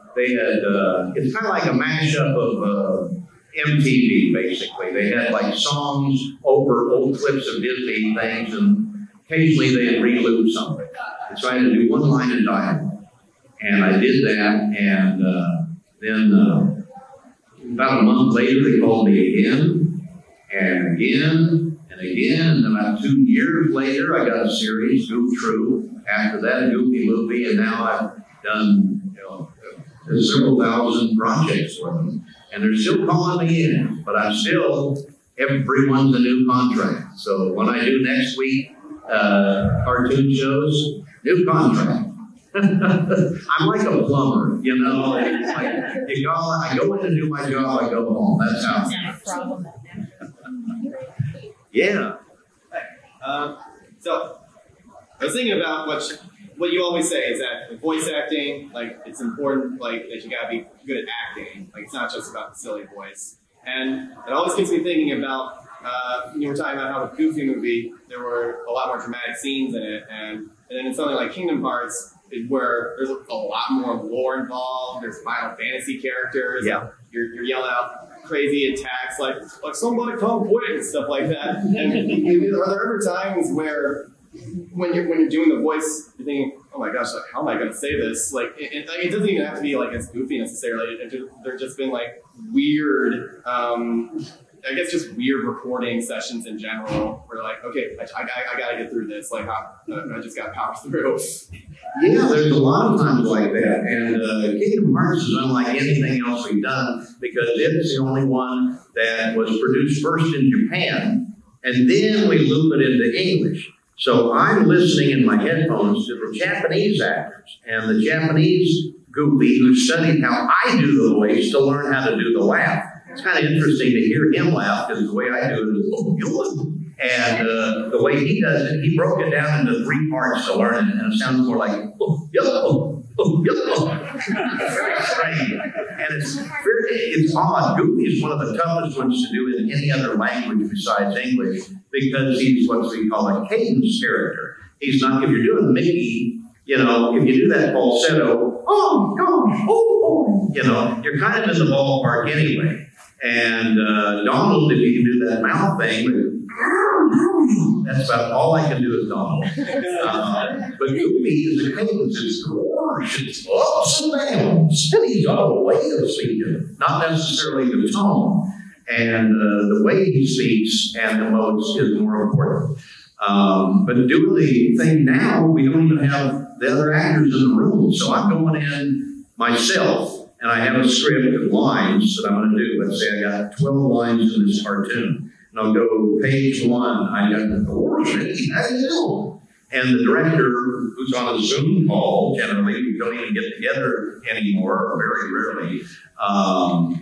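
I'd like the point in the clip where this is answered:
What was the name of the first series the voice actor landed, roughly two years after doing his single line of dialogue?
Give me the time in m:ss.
0:25.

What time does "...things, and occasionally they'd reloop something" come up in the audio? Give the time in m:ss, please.
0:08.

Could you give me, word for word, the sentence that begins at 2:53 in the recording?
Um, but doing the thing now, we don't even have the other actors in the room.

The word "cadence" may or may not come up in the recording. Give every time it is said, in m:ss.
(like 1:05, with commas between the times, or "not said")
2:23, 2:41.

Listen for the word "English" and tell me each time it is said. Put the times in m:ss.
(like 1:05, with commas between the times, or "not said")
1:53, 2:21.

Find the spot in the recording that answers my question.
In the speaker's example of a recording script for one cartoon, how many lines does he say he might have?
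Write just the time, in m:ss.
3:03.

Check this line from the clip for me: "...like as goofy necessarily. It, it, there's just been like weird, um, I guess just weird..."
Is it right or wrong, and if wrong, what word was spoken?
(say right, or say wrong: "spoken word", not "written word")
right.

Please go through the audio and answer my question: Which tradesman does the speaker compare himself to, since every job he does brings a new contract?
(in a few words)
a plumber.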